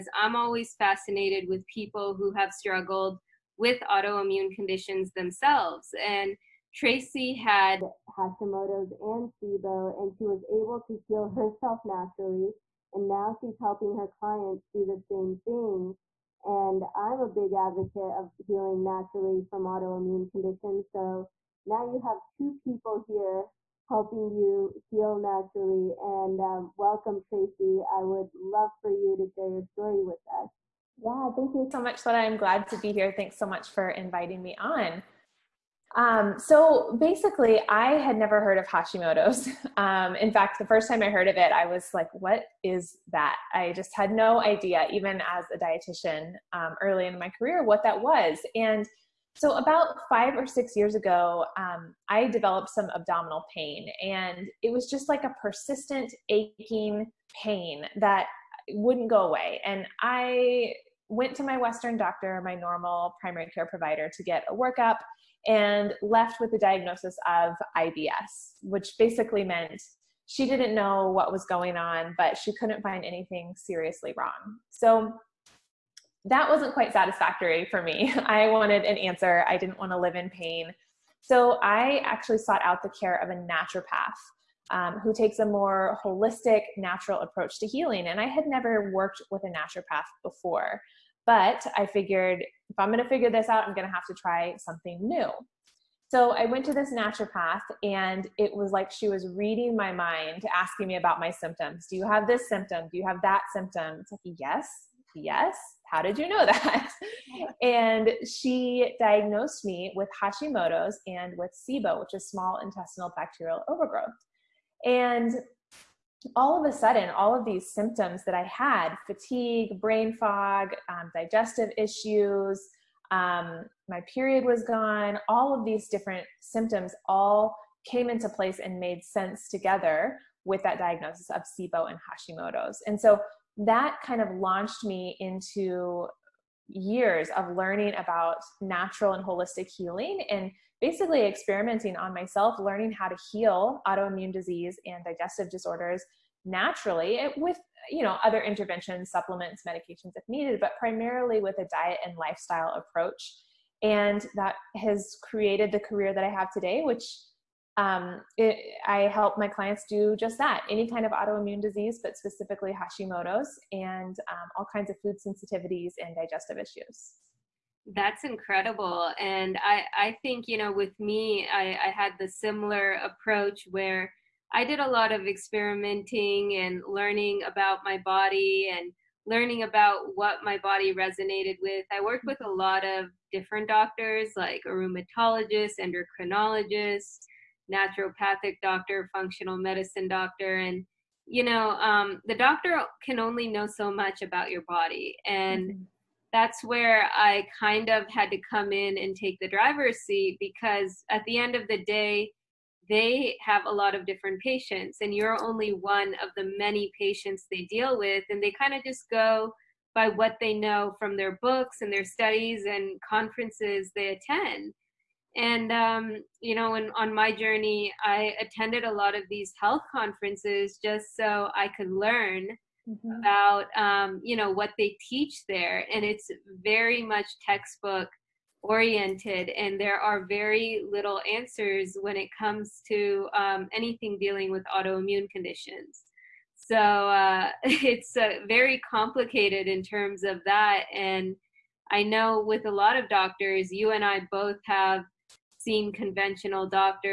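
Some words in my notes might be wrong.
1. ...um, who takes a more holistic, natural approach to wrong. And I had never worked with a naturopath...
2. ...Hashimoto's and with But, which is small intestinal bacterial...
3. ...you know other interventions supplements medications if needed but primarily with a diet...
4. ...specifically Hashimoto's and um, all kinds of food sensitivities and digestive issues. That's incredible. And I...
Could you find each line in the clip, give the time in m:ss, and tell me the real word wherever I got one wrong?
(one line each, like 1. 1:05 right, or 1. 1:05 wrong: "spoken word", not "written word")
1. 1:24 wrong: "healing", not "wrong"
2. 1:50 wrong: "SIBO", not "But"
3. 2:27 right
4. 2:42 right.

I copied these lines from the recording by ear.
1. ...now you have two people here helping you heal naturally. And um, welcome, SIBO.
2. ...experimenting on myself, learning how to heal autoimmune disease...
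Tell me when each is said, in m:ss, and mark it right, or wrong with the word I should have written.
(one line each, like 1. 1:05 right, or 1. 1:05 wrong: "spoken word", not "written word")
1. 0:21 wrong: "Tracy", not "SIBO"
2. 2:21 right.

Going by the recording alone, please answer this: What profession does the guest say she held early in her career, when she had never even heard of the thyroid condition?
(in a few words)
Dietitian.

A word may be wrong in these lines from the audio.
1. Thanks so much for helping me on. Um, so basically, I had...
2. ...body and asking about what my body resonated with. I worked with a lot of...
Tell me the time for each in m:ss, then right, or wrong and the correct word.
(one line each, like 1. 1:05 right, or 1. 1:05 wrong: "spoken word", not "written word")
1. 0:33 wrong: "inviting", not "helping"
2. 2:57 wrong: "learning", not "asking".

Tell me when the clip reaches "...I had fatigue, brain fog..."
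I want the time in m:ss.
1:58.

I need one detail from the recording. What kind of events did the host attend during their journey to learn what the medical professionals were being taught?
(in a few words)
Health conferences.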